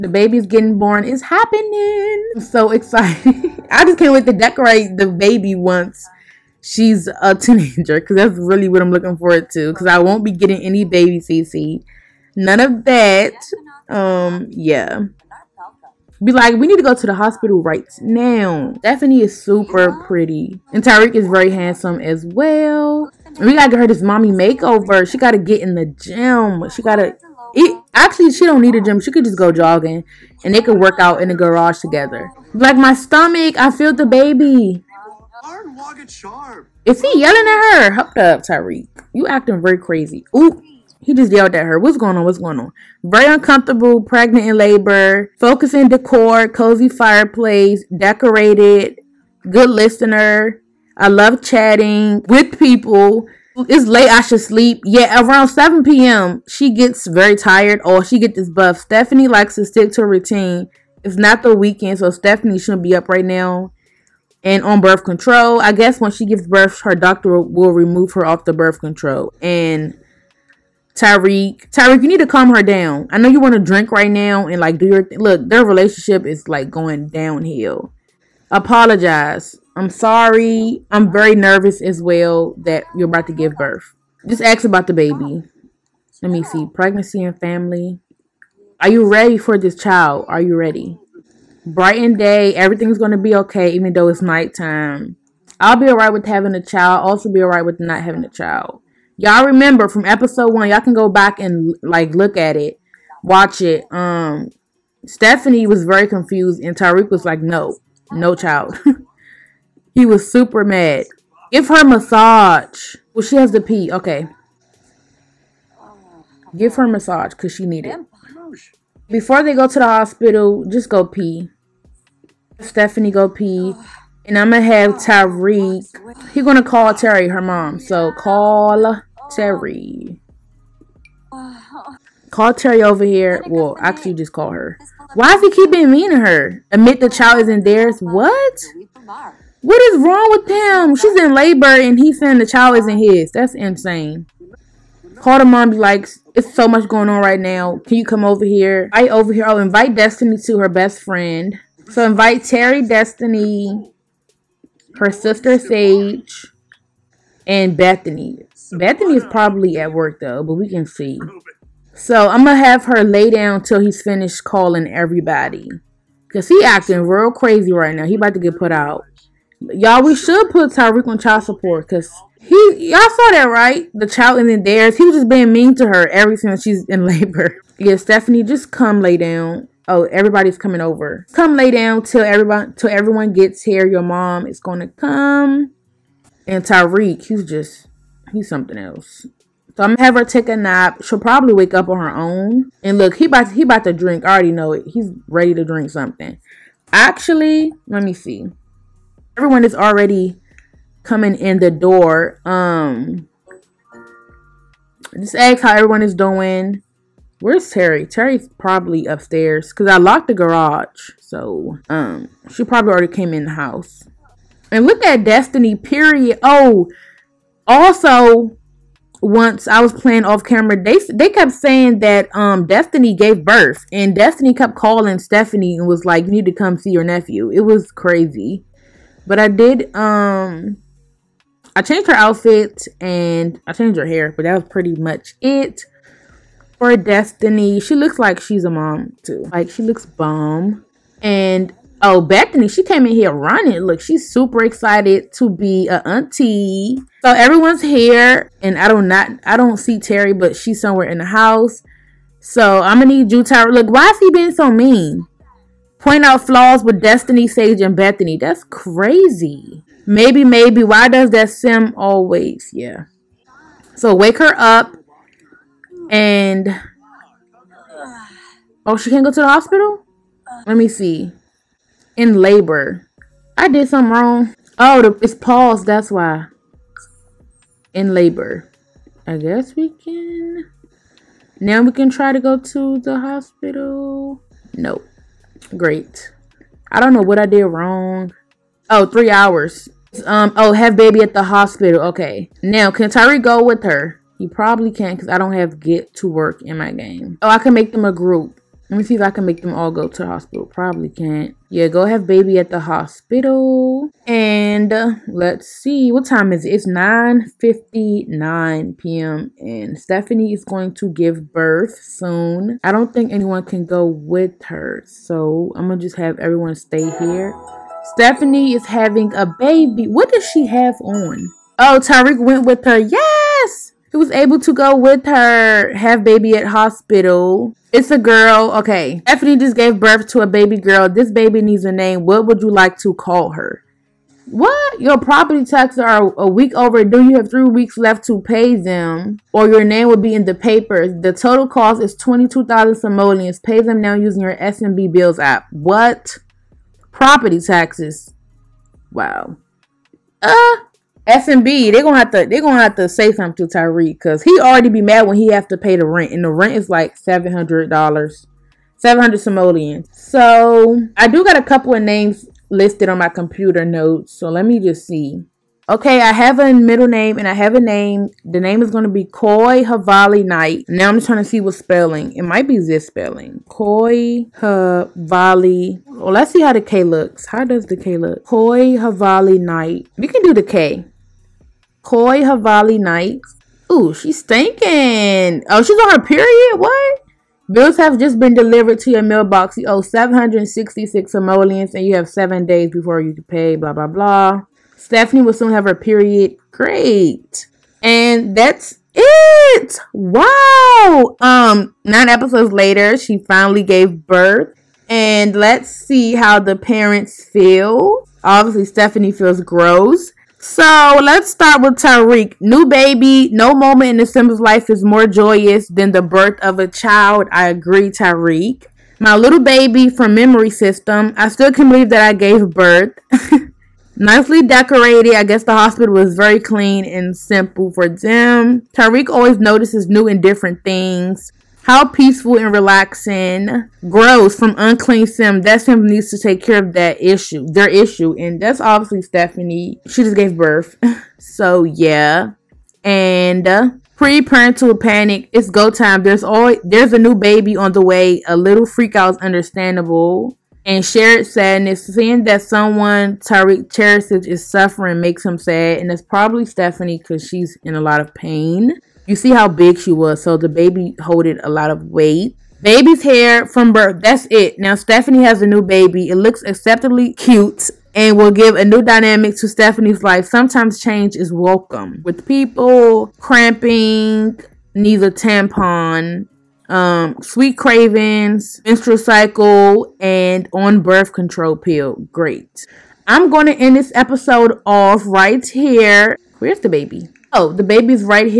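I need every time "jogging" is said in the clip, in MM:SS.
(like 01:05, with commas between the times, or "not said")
00:29.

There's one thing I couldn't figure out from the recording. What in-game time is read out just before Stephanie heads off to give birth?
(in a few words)
9:59 p.m.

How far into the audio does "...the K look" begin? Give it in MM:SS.
06:17.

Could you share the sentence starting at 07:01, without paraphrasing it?
I still can believe that I gave birth.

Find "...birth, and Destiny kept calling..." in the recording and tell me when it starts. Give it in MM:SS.
03:43.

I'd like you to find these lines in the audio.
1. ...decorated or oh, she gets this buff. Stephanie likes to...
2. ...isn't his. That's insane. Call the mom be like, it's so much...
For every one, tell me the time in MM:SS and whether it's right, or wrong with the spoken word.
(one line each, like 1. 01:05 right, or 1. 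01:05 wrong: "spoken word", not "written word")
1. 00:57 wrong: "tired", not "decorated"
2. 02:22 right.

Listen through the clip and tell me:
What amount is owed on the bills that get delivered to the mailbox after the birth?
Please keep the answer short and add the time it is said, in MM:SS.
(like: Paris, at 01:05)
766 simoleons, at 06:30.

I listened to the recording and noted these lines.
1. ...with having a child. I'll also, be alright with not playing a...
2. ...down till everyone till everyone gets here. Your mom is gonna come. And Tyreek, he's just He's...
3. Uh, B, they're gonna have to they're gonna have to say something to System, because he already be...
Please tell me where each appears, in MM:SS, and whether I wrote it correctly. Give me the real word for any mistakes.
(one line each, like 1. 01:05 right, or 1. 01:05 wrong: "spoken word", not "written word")
1. 01:36 wrong: "having", not "playing"
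2. 03:01 right
3. 05:50 wrong: "Tyree", not "System".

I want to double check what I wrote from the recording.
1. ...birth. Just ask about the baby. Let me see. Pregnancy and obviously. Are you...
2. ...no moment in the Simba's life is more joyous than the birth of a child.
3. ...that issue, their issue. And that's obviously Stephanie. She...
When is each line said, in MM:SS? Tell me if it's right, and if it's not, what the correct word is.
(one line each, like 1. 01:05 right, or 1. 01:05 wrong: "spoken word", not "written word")
1. 01:23 wrong: "family", not "obviously"
2. 06:53 right
3. 07:16 right.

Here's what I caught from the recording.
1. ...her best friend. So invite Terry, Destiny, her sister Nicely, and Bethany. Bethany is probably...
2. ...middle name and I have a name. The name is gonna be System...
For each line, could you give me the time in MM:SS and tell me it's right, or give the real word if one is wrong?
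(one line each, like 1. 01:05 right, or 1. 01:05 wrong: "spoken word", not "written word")
1. 02:30 wrong: "Sage", not "Nicely"
2. 06:06 wrong: "Koi", not "System".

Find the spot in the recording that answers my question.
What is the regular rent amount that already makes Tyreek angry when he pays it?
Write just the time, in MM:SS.
05:58.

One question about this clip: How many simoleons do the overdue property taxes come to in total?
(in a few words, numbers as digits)
22,000.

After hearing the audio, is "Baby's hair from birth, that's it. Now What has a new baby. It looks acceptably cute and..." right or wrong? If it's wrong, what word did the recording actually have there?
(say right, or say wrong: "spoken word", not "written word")
wrong: "Stephanie", not "What".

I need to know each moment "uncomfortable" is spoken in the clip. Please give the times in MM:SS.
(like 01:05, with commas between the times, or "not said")
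00:43.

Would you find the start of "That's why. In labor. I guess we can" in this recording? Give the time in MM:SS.
04:35.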